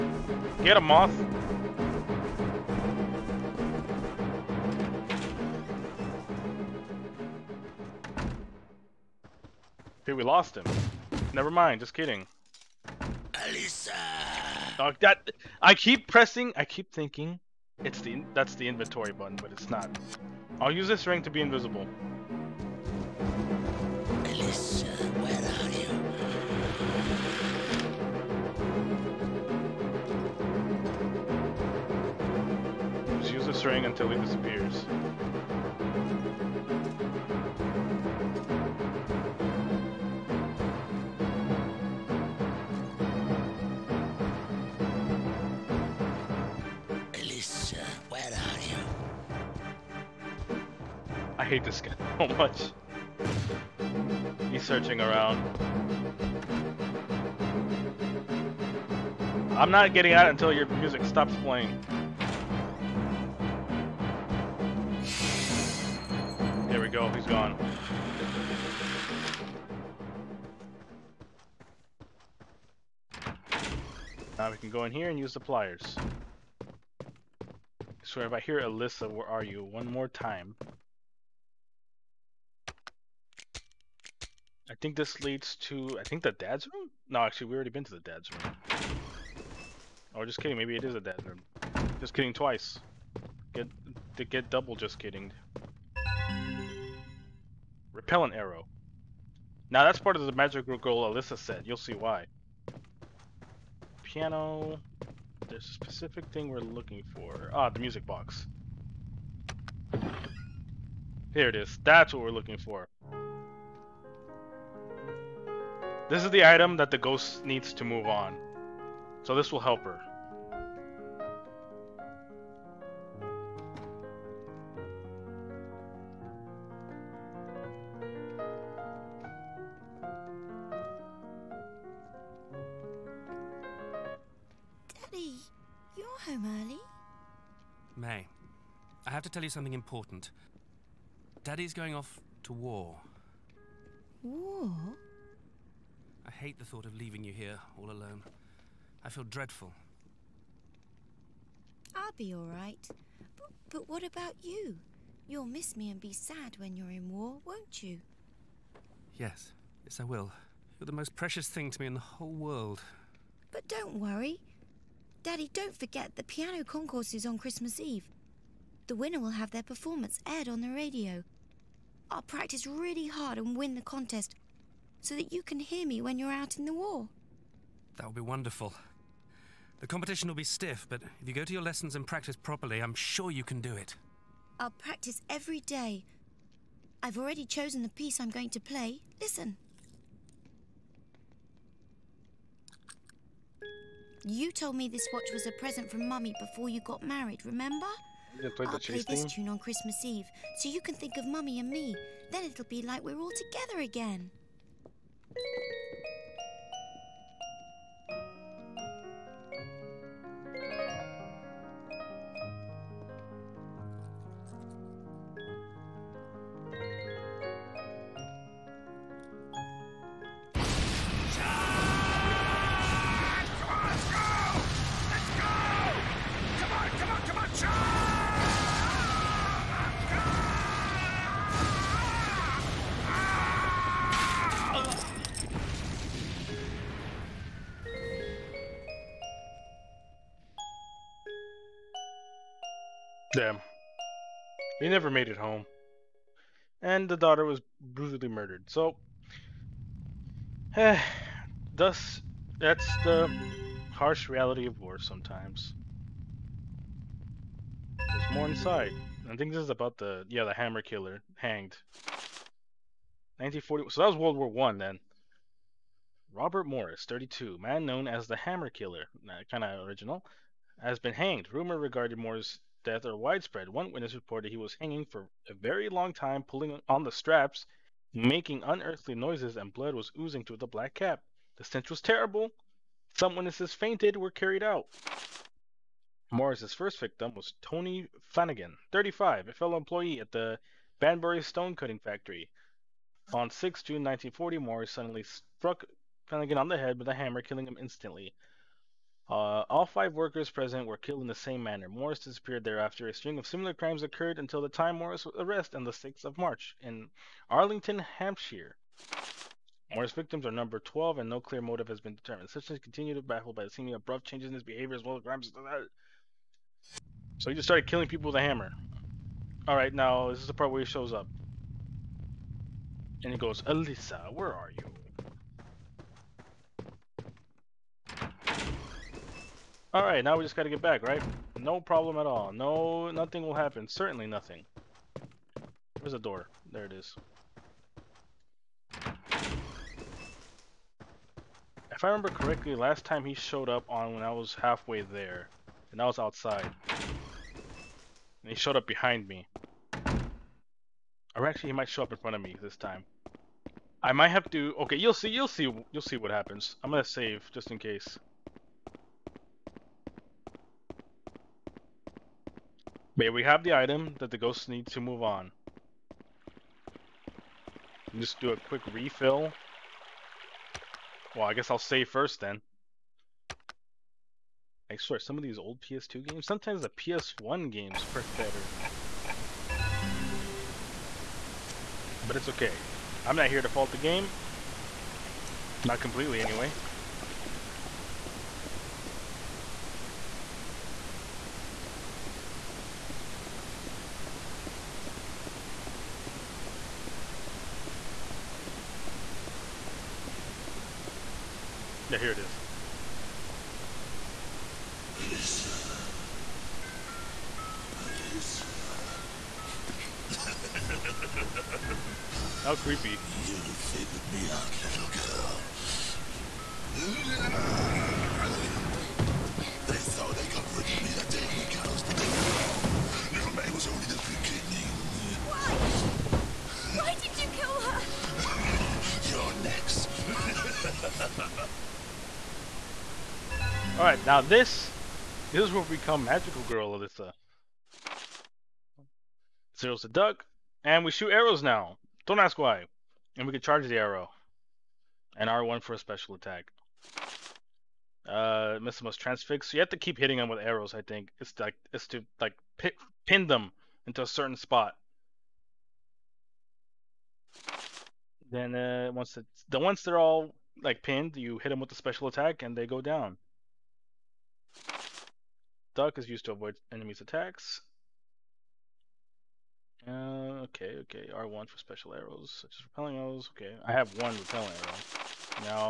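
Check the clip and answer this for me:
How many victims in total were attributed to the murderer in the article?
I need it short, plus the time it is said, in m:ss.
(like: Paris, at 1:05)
12, at 5:10.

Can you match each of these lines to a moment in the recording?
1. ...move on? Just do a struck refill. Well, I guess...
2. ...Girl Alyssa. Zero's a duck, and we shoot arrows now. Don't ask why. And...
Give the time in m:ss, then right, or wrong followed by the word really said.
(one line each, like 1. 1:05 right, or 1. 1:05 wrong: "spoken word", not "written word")
1. 6:04 wrong: "quick", not "struck"
2. 7:16 right.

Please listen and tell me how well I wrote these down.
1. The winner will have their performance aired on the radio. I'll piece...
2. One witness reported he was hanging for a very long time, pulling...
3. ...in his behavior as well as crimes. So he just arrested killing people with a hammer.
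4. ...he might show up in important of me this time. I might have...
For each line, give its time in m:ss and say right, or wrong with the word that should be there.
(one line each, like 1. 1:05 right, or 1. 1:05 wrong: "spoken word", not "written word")
1. 2:48 wrong: "practice", not "piece"
2. 4:33 right
3. 5:14 wrong: "started", not "arrested"
4. 5:51 wrong: "front", not "important".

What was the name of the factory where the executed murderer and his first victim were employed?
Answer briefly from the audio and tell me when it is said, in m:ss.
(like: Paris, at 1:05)
Banbury stone cutting factory, at 4:50.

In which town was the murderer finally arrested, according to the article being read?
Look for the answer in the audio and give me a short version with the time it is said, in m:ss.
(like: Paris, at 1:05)
Arlington, at 5:07.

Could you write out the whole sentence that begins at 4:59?
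Uh, all five workers present were killed in the same manner.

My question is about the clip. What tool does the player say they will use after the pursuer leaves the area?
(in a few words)
pliers.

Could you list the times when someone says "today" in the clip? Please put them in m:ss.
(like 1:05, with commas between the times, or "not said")
not said.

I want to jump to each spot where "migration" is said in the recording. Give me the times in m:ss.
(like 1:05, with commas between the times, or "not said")
not said.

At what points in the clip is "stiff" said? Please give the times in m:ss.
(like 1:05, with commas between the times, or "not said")
3:00.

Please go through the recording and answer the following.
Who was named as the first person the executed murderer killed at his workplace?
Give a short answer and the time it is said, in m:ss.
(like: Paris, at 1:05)
Tony Flanagan, at 4:47.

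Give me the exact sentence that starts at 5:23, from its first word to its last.
And he goes, Alyssa, where are you?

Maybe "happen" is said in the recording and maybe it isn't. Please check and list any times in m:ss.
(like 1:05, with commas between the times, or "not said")
5:33, 5:56.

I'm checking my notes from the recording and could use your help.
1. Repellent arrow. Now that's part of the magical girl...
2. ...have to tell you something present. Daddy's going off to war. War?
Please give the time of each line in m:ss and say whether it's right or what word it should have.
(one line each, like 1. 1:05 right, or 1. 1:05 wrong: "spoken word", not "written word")
1. 1:37 right
2. 2:19 wrong: "important", not "present".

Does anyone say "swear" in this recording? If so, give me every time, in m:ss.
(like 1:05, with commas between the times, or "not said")
1:18, 6:14.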